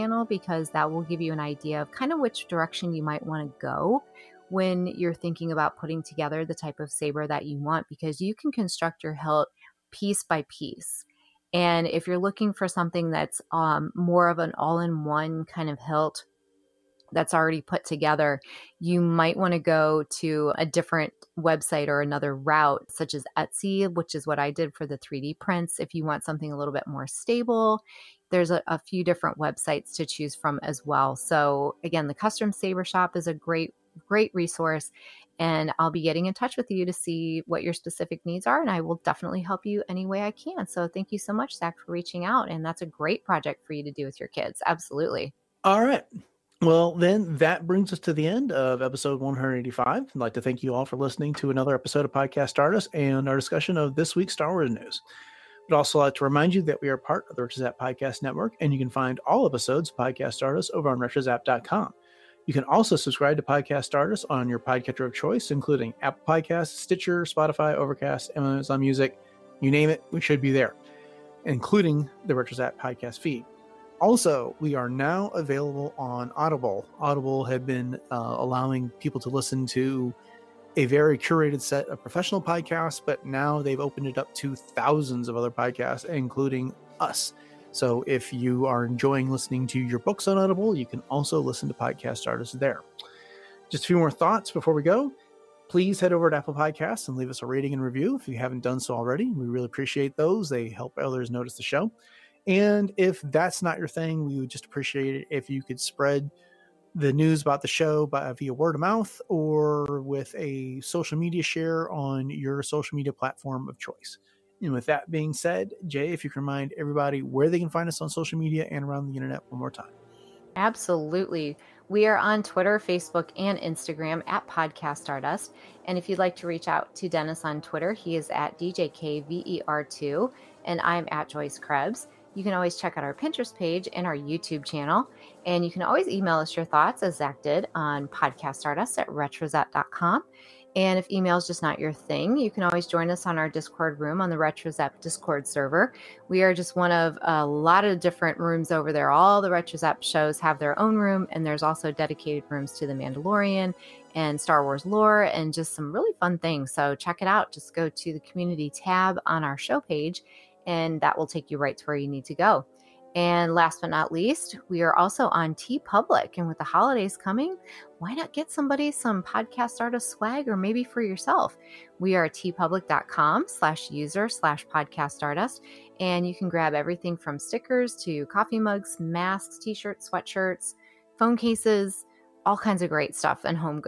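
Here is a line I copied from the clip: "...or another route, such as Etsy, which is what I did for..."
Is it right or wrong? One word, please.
right.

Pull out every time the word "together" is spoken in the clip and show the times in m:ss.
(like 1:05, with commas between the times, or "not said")
0:06, 0:17.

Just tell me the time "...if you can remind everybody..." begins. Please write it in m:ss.
1:56.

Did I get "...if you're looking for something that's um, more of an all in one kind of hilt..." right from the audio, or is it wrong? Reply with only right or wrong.
right.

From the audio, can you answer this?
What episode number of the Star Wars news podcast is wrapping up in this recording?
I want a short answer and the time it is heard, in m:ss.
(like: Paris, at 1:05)
185, at 0:49.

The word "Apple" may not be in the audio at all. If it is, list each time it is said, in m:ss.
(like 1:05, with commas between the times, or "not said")
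1:06, 1:36.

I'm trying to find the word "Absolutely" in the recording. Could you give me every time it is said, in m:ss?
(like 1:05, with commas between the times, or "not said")
0:44, 2:00.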